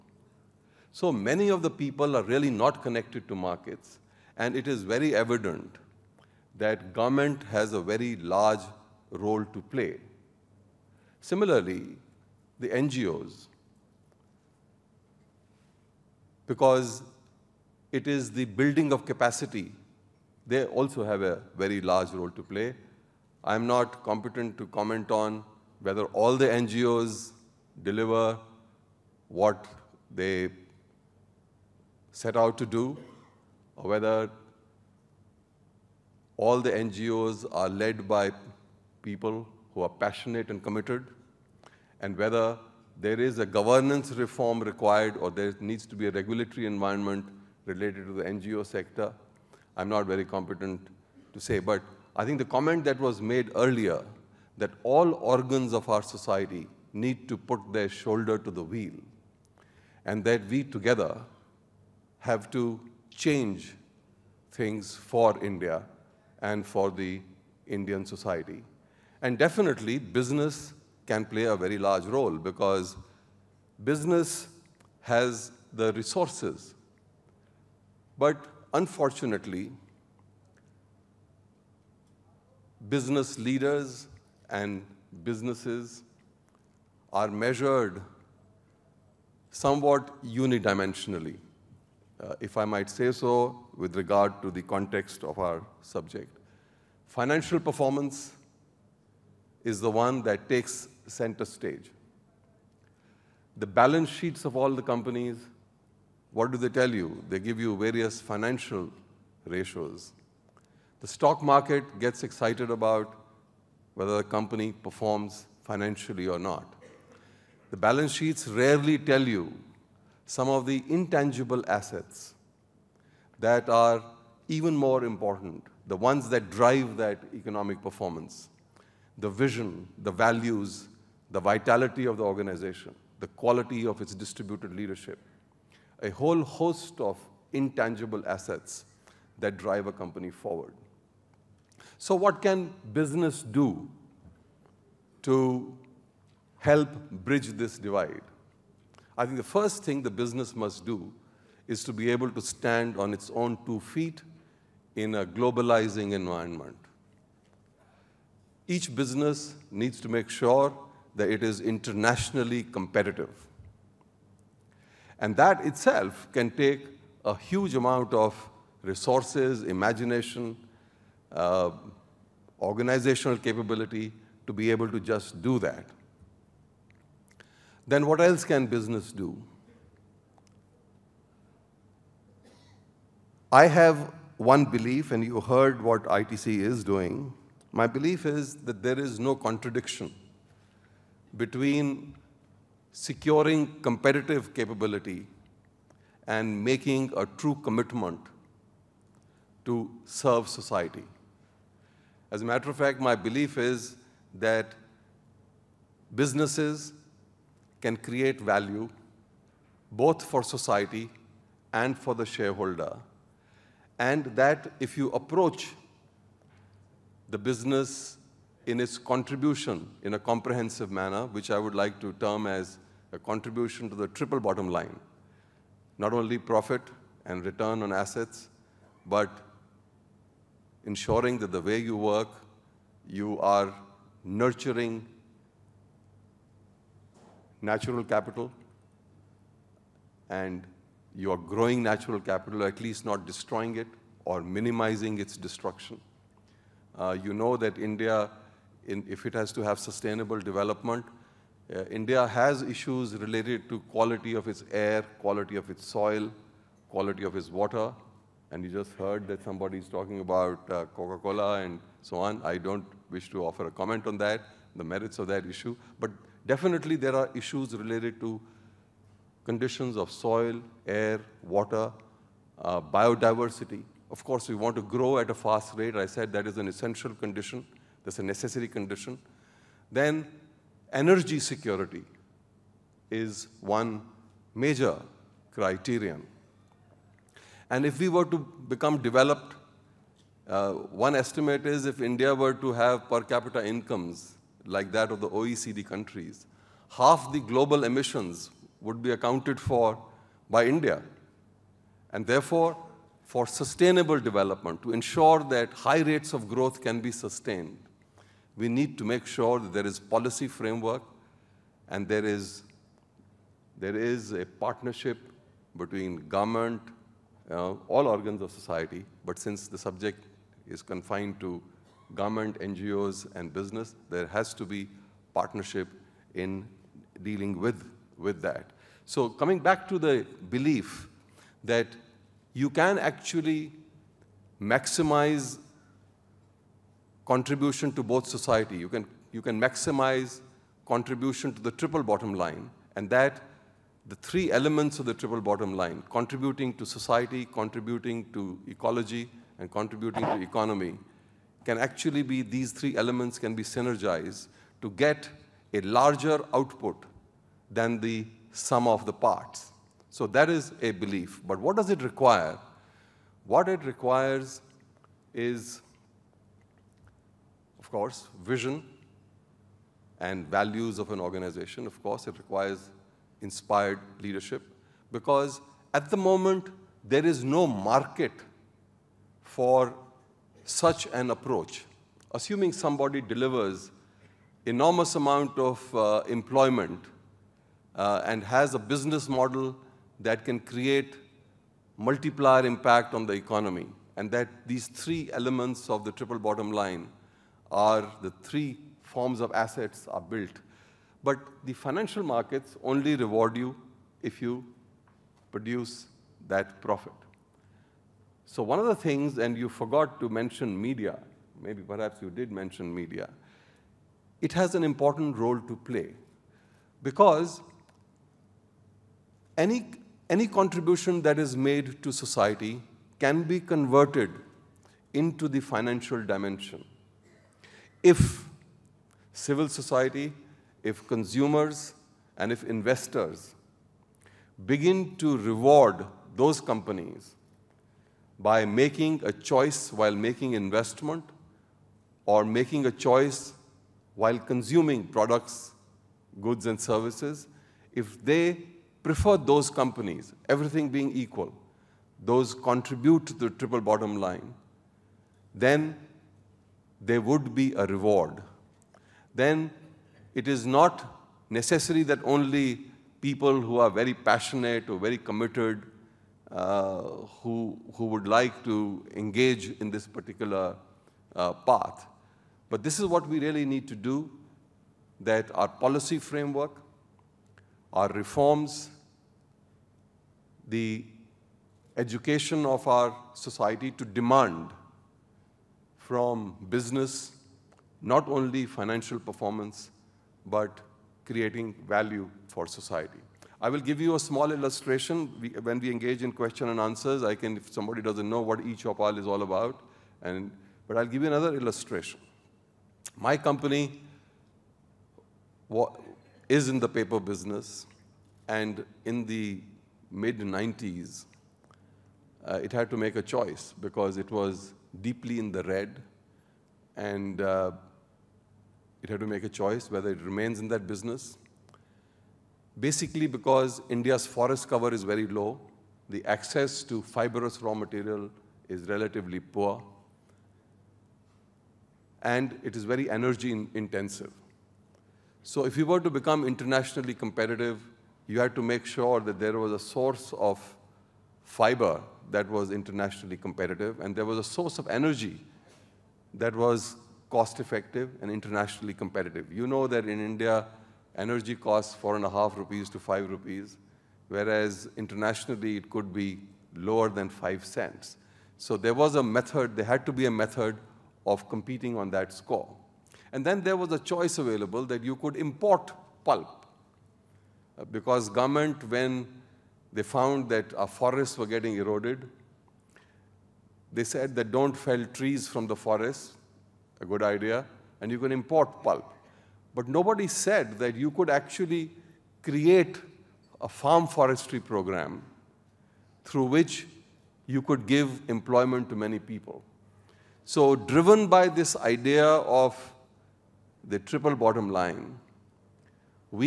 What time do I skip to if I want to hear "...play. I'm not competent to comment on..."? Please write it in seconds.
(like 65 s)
22 s.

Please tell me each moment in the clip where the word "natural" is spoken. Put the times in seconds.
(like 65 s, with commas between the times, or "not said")
237 s, 241 s.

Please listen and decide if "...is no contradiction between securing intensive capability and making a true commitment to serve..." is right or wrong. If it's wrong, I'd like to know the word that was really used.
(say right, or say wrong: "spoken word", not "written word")
wrong: "competitive", not "intensive".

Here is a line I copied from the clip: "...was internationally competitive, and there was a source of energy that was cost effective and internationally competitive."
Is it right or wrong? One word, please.
right.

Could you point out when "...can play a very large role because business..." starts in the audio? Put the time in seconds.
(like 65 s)
71 s.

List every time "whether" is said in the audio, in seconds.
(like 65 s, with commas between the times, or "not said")
25 s, 33 s, 42 s, 113 s, 519 s.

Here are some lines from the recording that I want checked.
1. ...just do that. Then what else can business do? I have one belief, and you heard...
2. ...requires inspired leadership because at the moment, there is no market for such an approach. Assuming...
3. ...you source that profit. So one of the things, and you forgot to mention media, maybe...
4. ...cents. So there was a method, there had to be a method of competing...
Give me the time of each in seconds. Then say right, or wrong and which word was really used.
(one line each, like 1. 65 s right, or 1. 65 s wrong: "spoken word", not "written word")
1. 175 s right
2. 372 s right
3. 404 s wrong: "produce", not "source"
4. 557 s right.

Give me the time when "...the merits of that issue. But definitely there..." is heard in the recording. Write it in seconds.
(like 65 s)
264 s.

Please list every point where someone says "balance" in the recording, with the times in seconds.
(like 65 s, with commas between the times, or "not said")
103 s, 117 s.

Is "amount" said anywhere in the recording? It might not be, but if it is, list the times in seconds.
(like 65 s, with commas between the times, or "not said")
167 s, 385 s.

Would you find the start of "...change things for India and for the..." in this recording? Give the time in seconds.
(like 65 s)
63 s.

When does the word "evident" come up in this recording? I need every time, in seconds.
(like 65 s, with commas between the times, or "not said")
5 s.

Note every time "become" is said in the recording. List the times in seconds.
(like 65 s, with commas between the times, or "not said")
288 s, 536 s.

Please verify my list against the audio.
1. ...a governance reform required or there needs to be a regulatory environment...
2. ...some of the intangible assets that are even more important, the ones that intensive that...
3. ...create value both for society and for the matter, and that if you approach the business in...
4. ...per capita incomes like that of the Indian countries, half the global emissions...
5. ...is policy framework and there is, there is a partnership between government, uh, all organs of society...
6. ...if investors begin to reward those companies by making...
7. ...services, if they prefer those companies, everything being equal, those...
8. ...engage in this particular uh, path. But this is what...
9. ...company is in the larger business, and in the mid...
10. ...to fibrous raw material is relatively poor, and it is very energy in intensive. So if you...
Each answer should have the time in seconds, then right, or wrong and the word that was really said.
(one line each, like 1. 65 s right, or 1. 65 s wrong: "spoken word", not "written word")
1. 43 s right
2. 120 s wrong: "drive", not "intensive"
3. 207 s wrong: "shareholder", not "matter"
4. 293 s wrong: "OECD", not "Indian"
5. 309 s right
6. 432 s right
7. 446 s right
8. 469 s right
9. 503 s wrong: "paper", not "larger"
10. 526 s right.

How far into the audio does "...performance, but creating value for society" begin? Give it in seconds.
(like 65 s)
489 s.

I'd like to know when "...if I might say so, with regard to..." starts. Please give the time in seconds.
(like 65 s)
92 s.